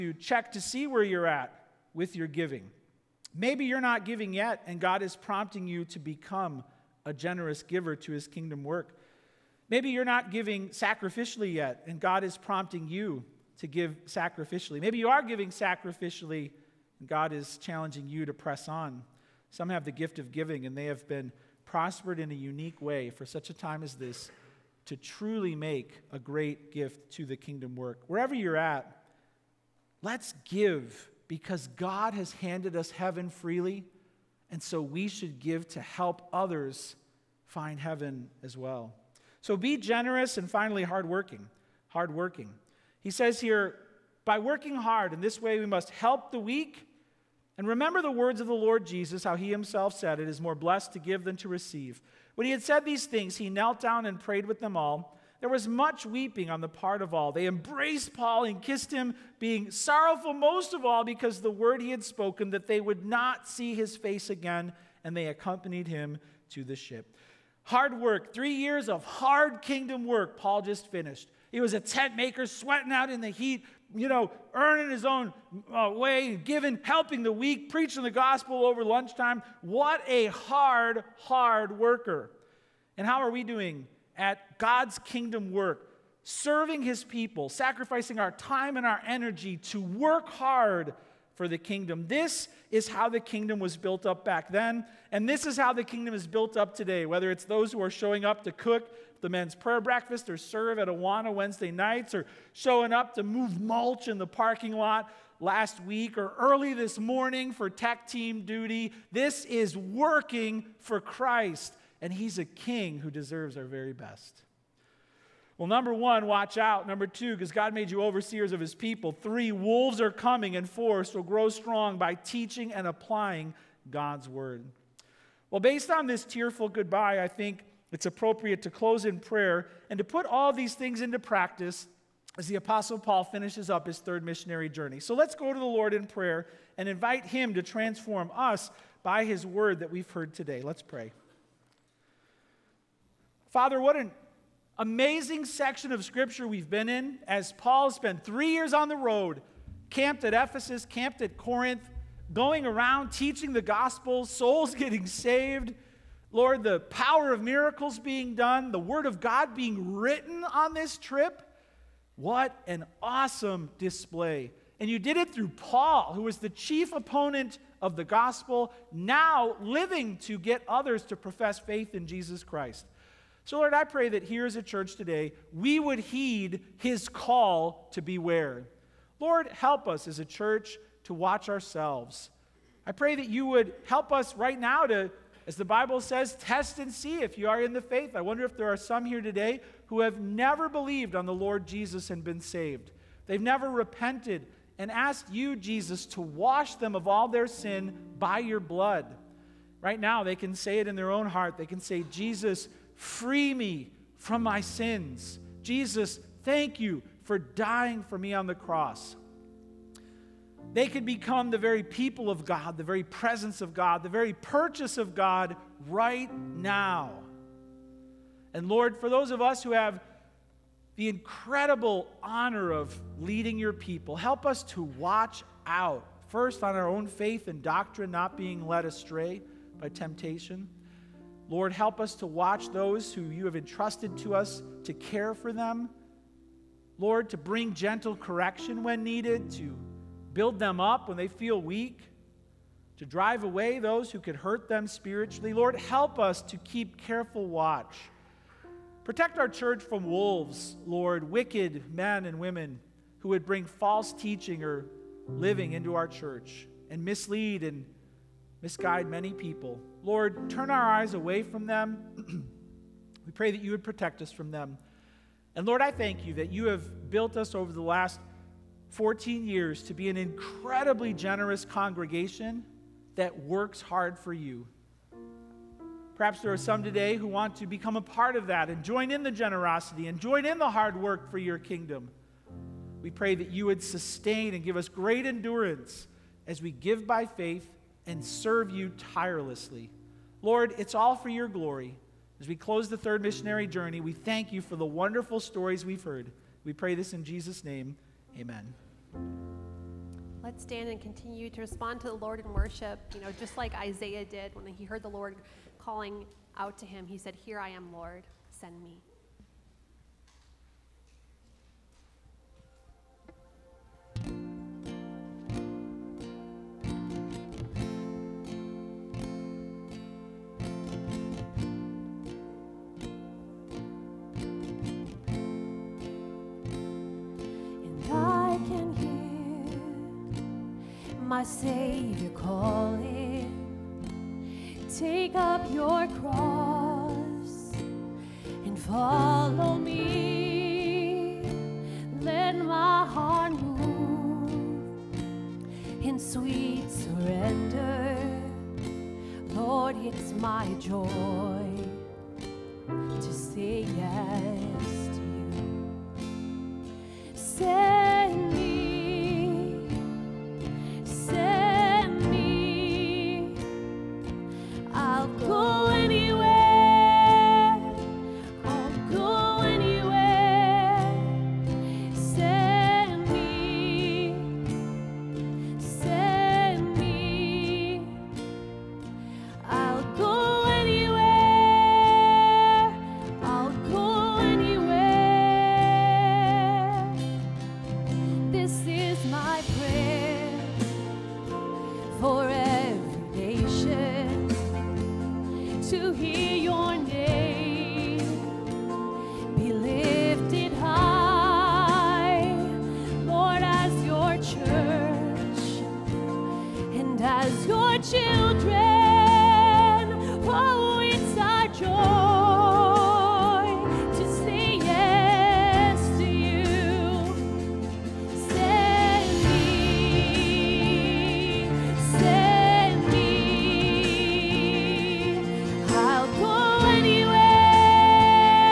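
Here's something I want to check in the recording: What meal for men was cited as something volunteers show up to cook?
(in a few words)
Men's prayer breakfast.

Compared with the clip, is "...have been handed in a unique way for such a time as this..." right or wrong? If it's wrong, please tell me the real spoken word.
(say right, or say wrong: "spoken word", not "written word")
wrong: "prospered", not "handed".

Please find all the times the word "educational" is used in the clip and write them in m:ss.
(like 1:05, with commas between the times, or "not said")
not said.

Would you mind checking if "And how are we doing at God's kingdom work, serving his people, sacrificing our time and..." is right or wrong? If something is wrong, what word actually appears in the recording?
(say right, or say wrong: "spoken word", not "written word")
right.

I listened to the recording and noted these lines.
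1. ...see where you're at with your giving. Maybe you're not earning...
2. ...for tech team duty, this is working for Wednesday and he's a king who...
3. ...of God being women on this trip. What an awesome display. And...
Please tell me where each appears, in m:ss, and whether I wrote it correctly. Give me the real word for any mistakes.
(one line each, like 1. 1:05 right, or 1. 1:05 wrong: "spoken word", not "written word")
1. 0:00 wrong: "giving", not "earning"
2. 1:47 wrong: "Christ", not "Wednesday"
3. 2:39 wrong: "written", not "women".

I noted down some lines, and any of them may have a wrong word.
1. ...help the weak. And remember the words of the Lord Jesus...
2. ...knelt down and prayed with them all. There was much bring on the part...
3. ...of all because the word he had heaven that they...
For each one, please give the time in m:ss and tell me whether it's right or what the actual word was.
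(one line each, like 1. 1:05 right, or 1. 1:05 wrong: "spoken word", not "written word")
1. 0:45 right
2. 0:53 wrong: "weeping", not "bring"
3. 1:00 wrong: "spoken", not "heaven".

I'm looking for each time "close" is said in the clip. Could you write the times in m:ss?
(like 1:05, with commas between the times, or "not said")
2:08, 4:52.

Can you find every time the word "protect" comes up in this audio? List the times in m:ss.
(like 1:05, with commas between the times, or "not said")
4:09, 4:23.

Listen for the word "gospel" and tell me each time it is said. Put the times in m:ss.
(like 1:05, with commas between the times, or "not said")
1:18, 2:33, 2:48.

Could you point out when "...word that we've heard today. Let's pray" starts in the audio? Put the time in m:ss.
2:19.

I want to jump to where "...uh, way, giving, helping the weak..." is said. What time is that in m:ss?
1:15.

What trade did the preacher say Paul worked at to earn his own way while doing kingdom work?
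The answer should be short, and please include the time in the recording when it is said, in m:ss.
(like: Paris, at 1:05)
Tent maker, at 1:11.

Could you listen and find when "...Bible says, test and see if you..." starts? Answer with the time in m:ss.
3:05.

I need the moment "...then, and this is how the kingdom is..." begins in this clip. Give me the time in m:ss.
1:34.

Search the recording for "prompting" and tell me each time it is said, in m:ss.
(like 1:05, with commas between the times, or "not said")
0:05, 0:12.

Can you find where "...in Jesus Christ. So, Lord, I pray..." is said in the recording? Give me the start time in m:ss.
2:51.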